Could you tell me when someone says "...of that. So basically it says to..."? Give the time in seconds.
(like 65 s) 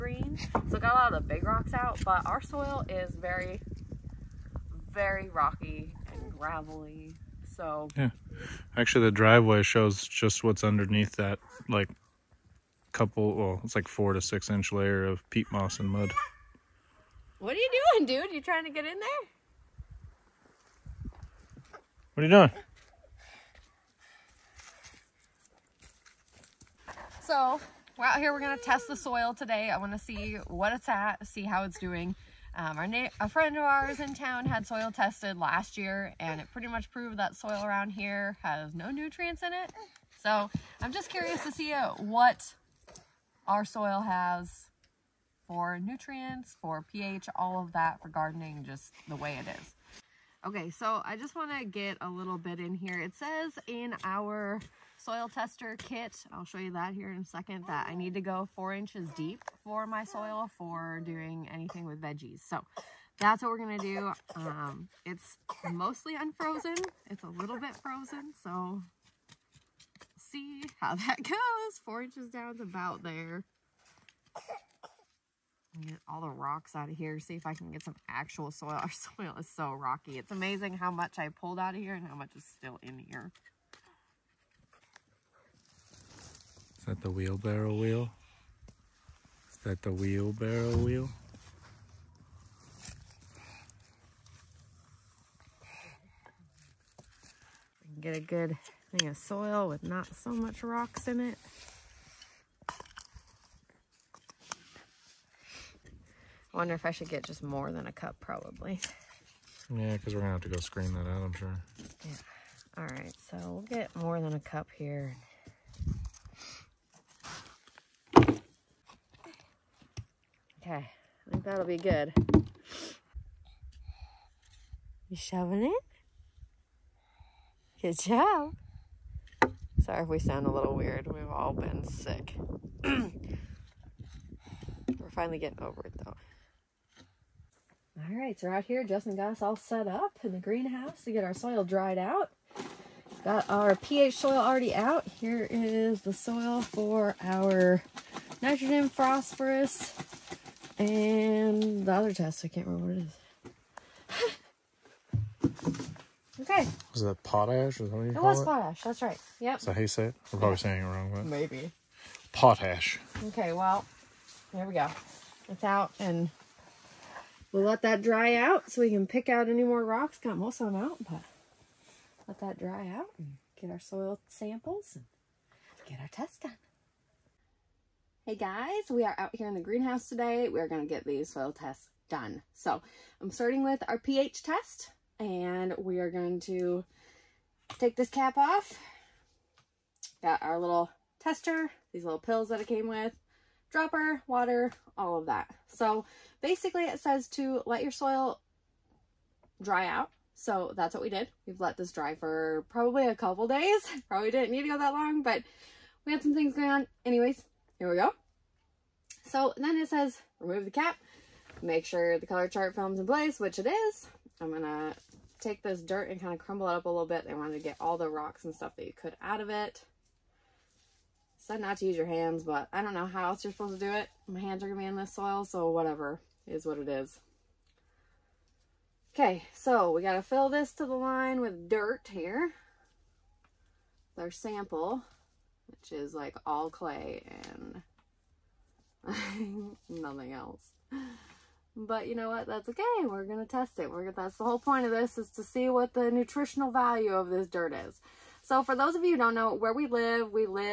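195 s.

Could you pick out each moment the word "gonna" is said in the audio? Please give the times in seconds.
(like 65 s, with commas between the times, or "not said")
214 s, 243 s.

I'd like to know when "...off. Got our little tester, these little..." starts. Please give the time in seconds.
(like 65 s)
188 s.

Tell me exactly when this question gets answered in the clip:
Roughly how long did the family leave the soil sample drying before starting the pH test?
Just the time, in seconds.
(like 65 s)
203 s.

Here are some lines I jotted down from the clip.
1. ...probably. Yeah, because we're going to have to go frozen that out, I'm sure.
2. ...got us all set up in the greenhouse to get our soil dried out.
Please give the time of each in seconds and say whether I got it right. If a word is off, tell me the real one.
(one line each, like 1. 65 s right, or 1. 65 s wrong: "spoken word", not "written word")
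1. 108 s wrong: "screen", not "frozen"
2. 139 s right.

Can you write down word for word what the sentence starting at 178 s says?
Hey guys, we are out here in the greenhouse today.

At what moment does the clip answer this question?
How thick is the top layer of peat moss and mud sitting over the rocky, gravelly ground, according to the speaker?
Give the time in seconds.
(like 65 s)
13 s.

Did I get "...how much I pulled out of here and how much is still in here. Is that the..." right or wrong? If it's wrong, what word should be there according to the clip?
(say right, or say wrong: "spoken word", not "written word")
right.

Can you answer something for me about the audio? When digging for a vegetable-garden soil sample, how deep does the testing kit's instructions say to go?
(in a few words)
4 inches.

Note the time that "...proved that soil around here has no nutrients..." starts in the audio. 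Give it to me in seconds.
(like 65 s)
36 s.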